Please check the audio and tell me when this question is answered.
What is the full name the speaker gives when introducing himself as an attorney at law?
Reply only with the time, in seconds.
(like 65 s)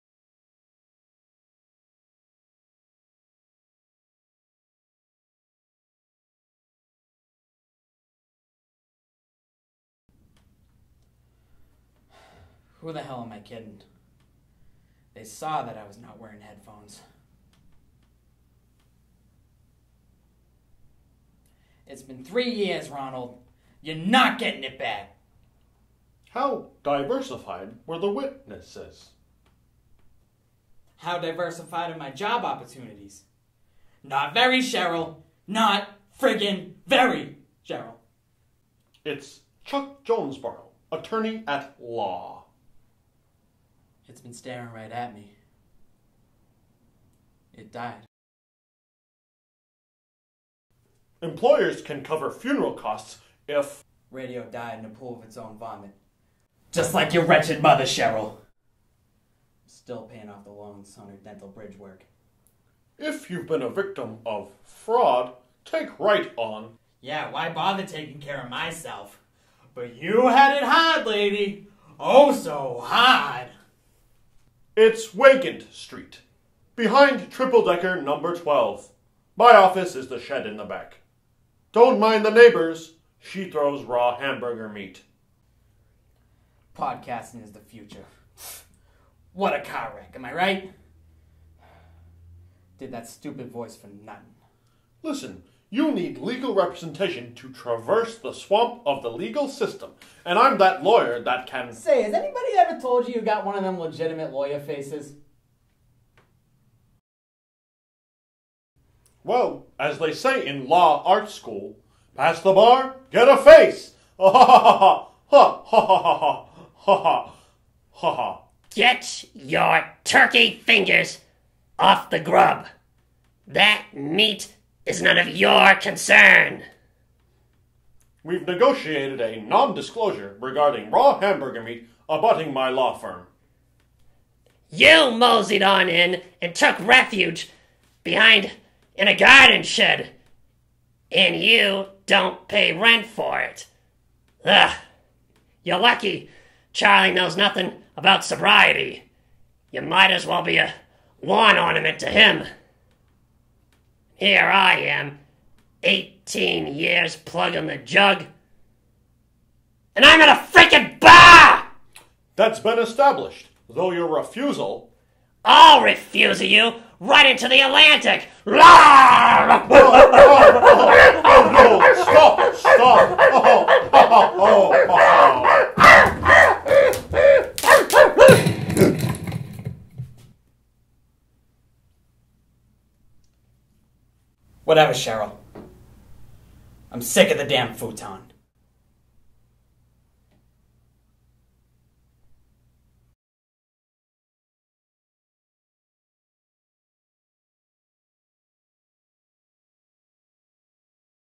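39 s.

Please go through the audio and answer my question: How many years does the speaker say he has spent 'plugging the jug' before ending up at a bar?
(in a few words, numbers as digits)
18.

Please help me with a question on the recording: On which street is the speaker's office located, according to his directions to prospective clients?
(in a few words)
Wakent Street.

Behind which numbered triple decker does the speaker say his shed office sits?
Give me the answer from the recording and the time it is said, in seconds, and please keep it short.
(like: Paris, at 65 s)
12, at 78 s.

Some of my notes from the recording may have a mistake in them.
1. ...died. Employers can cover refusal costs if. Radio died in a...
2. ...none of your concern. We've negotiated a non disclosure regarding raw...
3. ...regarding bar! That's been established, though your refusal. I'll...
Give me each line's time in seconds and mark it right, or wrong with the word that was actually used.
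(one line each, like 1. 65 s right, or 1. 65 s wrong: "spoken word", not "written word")
1. 47 s wrong: "funeral", not "refusal"
2. 125 s right
3. 160 s wrong: "freaking", not "regarding".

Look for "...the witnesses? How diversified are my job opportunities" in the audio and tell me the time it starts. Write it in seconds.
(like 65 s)
27 s.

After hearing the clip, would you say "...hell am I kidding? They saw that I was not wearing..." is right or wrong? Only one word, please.
right.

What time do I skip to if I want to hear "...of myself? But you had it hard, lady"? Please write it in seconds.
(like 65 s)
68 s.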